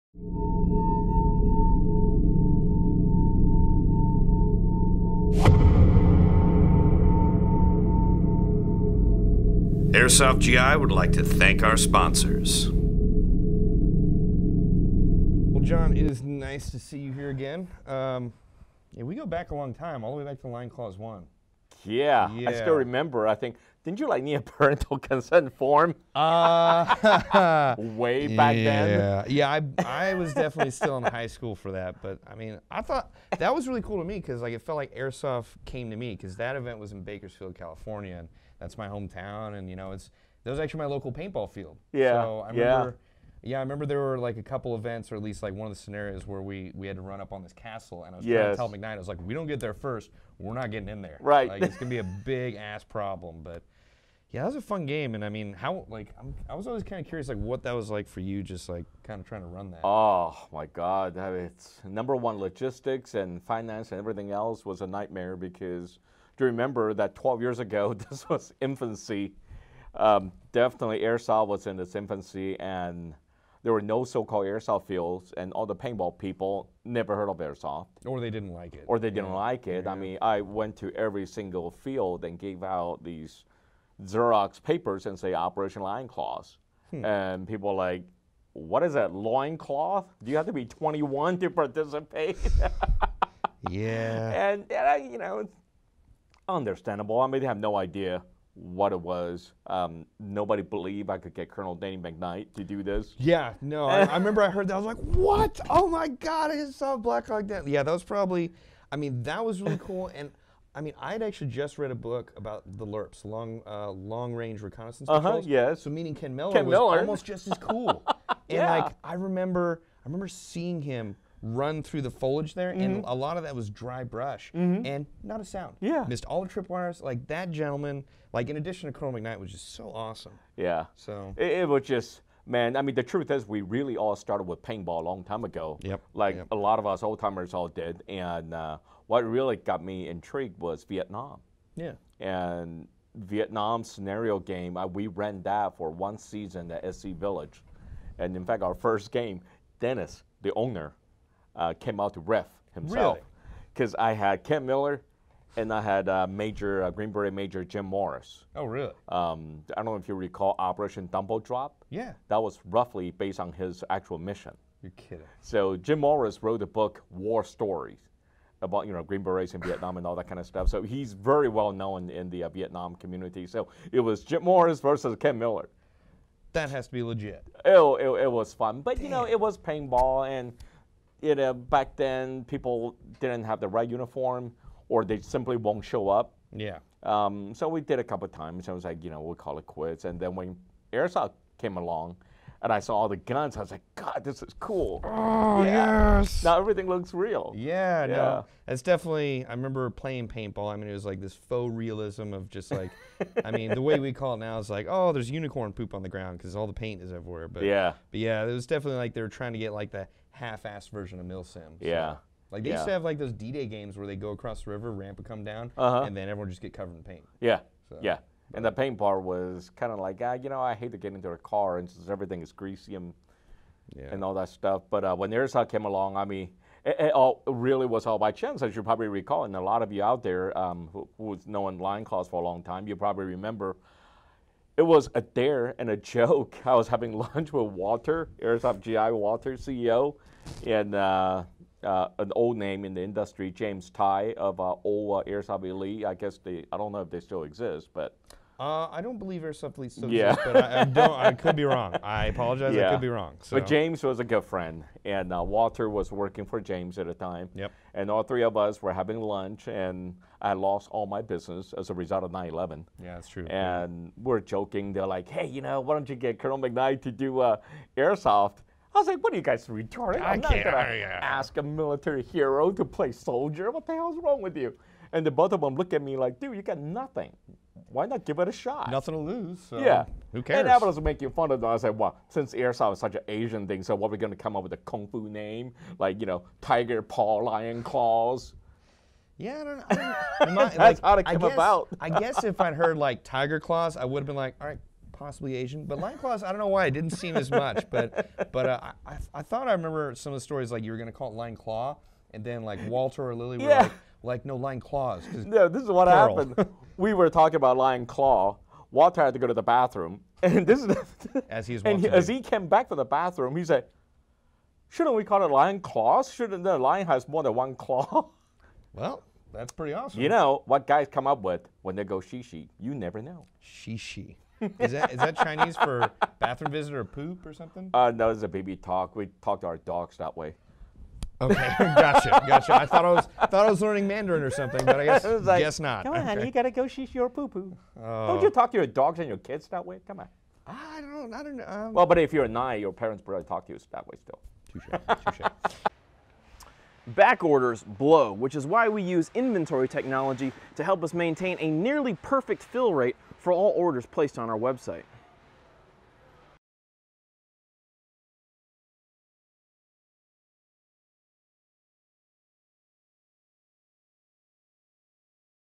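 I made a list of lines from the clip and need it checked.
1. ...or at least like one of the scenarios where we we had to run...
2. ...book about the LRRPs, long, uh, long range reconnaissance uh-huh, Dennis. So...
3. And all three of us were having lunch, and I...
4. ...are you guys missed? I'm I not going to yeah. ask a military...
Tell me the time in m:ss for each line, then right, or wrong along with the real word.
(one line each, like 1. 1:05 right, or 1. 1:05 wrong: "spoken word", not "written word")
1. 0:45 right
2. 1:51 wrong: "Yeah", not "Dennis"
3. 4:17 right
4. 4:29 wrong: "retarded", not "missed".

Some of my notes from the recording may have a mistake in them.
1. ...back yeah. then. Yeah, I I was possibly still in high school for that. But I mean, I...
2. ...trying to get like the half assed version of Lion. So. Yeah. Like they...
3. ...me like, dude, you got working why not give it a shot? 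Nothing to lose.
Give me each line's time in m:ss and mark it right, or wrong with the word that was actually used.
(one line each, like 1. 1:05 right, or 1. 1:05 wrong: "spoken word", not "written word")
1. 0:28 wrong: "definitely", not "possibly"
2. 3:29 wrong: "MilSim", not "Lion"
3. 4:36 wrong: "nothing", not "working".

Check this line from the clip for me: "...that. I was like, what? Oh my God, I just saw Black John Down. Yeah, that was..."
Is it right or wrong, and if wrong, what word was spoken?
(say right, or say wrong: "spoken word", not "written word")
wrong: "Hawk", not "John".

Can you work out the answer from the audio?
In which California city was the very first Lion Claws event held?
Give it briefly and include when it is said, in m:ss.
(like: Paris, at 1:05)
Bakersfield, at 0:37.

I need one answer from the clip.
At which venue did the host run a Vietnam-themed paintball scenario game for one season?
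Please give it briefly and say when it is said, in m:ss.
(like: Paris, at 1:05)
SC Village, at 2:26.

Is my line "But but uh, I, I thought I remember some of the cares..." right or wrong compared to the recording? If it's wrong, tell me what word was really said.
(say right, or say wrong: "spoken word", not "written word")
wrong: "stories", not "cares".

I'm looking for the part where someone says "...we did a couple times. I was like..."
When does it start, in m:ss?
3:07.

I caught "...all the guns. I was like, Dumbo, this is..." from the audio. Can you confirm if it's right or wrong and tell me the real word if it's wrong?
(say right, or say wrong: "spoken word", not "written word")
wrong: "God", not "Dumbo".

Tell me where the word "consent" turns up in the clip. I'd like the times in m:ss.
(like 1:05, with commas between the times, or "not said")
0:24.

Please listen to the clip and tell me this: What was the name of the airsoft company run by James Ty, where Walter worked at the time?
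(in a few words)
Airsoft Elite.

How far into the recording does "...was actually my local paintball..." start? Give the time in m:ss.
0:40.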